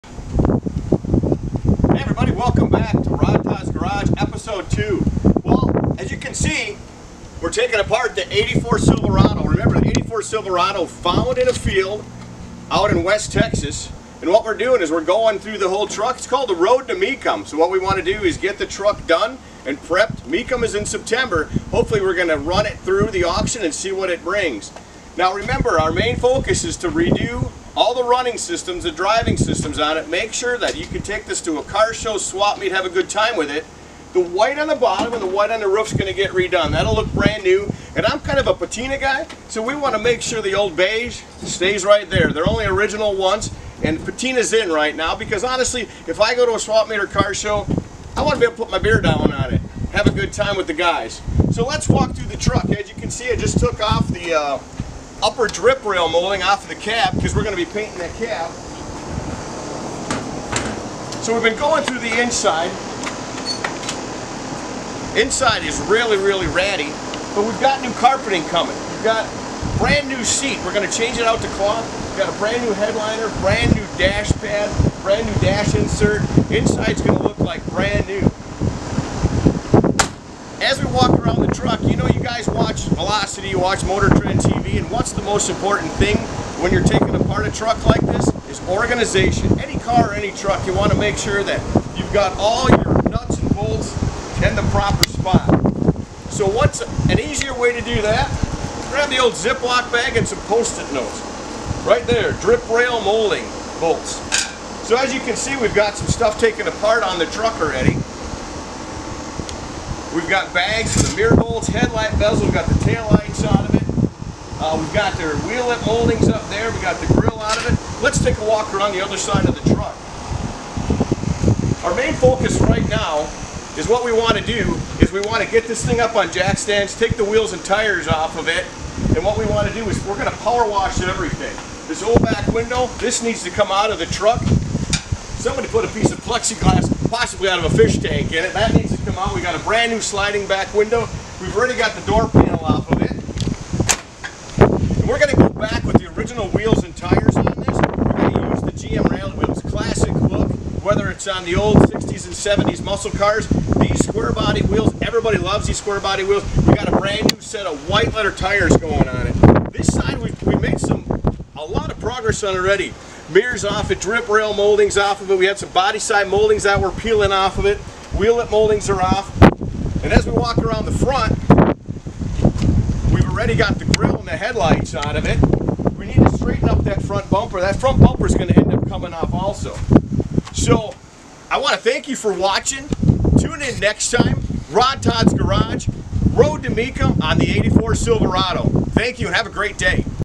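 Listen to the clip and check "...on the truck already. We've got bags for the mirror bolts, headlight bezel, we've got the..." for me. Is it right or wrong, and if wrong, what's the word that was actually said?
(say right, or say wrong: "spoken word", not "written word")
right.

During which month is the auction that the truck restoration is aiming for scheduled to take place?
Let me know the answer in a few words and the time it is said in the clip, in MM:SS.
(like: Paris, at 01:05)
September, at 00:20.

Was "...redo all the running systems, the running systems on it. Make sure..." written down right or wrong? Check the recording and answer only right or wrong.
wrong.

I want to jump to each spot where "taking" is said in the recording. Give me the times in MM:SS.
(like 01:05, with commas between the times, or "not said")
00:07, 01:26.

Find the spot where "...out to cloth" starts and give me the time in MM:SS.
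01:11.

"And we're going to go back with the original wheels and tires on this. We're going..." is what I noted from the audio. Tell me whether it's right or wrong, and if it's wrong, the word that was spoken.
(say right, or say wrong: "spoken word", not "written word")
right.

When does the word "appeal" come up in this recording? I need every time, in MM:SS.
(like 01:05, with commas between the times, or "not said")
not said.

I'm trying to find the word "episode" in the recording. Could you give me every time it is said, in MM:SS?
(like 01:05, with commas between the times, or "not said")
00:04.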